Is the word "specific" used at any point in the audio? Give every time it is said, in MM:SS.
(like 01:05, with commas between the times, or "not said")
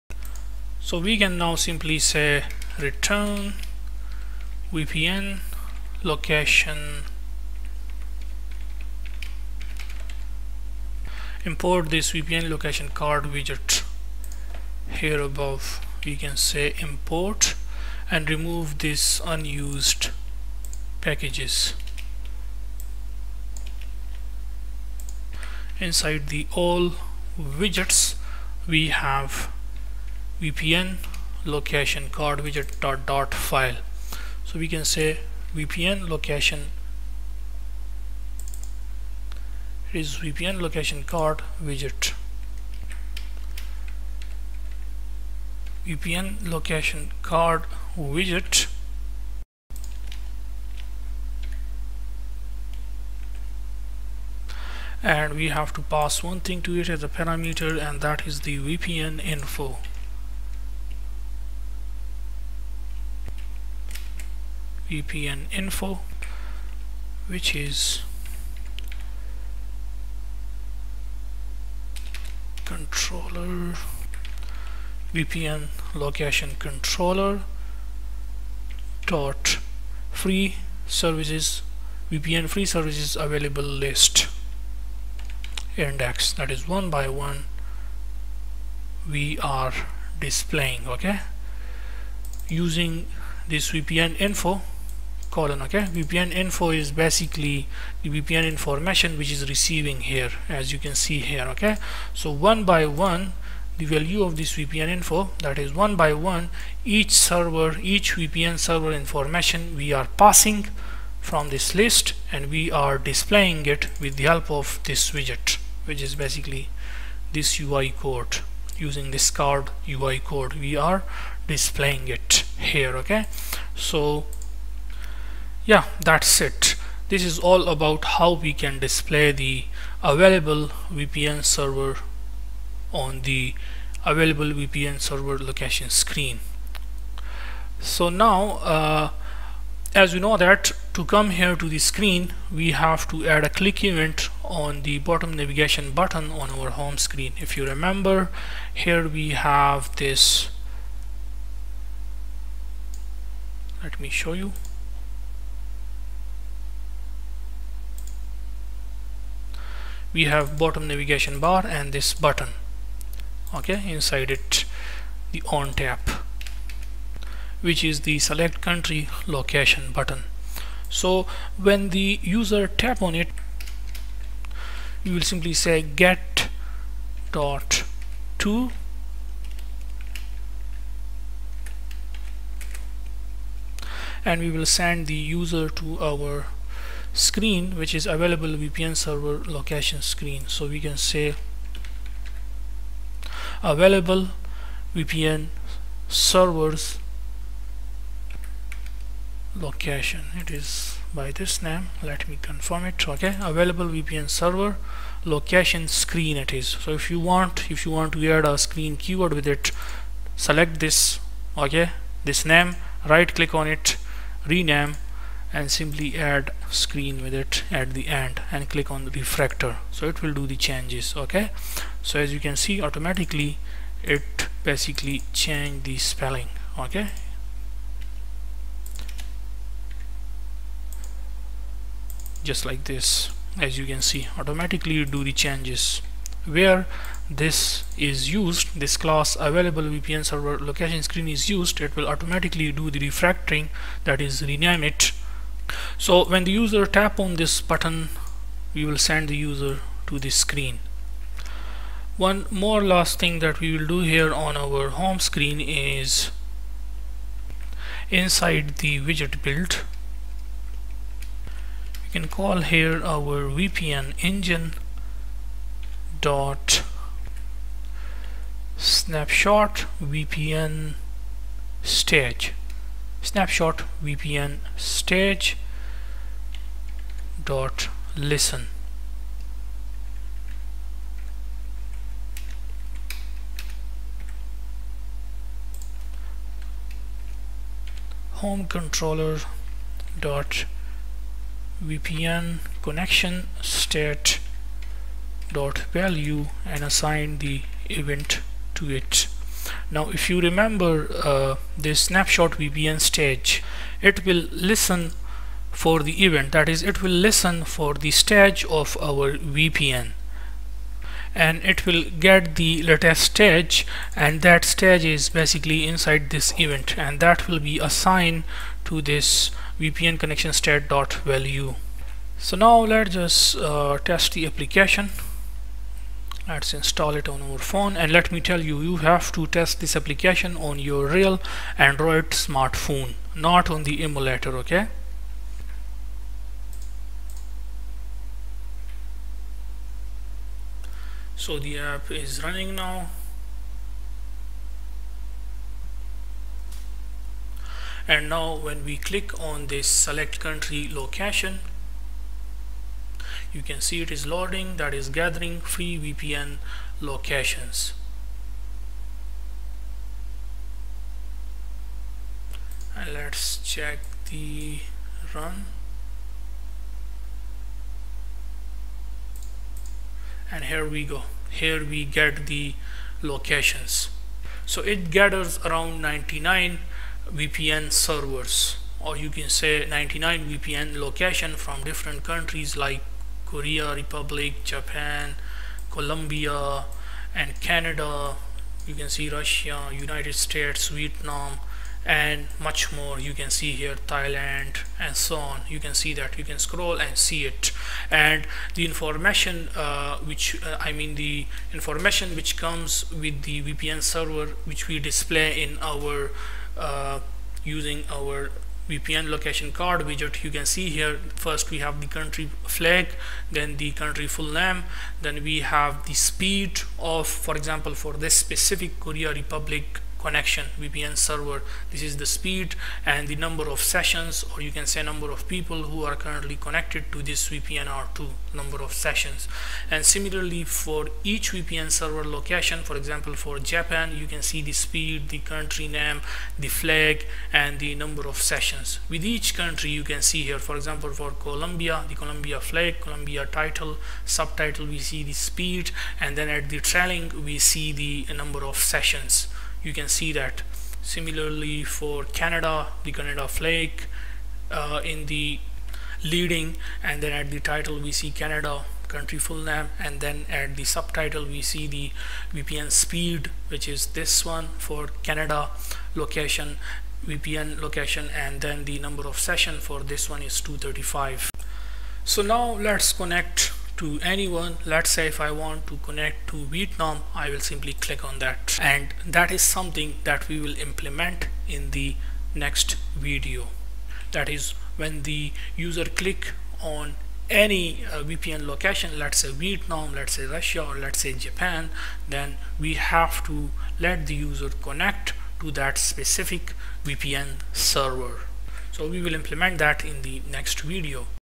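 06:58, 08:15.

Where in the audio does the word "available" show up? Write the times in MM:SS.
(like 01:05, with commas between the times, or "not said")
01:23, 02:10, 02:14, 03:08, 03:13, 03:23, 03:59.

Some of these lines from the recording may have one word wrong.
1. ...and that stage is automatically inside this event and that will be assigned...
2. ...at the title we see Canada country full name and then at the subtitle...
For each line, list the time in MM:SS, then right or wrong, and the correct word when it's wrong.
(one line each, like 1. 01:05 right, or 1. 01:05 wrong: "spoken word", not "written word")
1. 05:14 wrong: "basically", not "automatically"
2. 07:37 right.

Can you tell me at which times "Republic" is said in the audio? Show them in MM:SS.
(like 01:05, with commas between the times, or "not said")
06:23, 06:59.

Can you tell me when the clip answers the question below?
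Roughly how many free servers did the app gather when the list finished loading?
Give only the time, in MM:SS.
06:15.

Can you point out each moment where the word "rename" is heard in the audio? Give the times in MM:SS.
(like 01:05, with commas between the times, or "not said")
03:34, 04:04.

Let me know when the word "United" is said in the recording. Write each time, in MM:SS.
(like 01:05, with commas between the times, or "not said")
06:29.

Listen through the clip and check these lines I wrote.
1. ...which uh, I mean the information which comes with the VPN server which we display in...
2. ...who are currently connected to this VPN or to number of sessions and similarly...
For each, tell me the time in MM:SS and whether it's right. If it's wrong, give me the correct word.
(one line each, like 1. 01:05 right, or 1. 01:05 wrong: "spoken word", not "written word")
1. 06:40 right
2. 07:05 right.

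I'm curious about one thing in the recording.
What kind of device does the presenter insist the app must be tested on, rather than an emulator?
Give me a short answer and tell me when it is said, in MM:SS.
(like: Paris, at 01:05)
Real Android smartphone, at 05:31.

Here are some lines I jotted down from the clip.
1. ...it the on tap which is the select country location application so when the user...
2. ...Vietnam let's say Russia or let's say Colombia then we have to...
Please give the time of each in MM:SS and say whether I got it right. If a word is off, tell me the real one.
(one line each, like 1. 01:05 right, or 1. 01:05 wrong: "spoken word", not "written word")
1. 02:44 wrong: "button", not "application"
2. 08:09 wrong: "Japan", not "Colombia".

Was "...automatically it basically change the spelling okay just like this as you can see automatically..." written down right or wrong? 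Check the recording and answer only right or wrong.
right.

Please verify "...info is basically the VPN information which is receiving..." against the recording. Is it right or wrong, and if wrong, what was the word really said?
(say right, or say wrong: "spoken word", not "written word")
right.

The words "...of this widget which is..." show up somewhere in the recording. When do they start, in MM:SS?
01:54.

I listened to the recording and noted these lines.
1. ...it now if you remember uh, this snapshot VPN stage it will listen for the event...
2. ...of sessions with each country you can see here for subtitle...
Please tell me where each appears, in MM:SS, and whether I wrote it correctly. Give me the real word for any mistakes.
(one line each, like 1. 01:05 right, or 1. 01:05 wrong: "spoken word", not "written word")
1. 04:58 right
2. 07:18 wrong: "example", not "subtitle".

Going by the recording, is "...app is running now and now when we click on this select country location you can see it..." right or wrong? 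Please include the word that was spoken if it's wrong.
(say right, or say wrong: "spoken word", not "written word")
right.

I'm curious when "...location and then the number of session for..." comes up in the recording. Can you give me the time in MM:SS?
07:47.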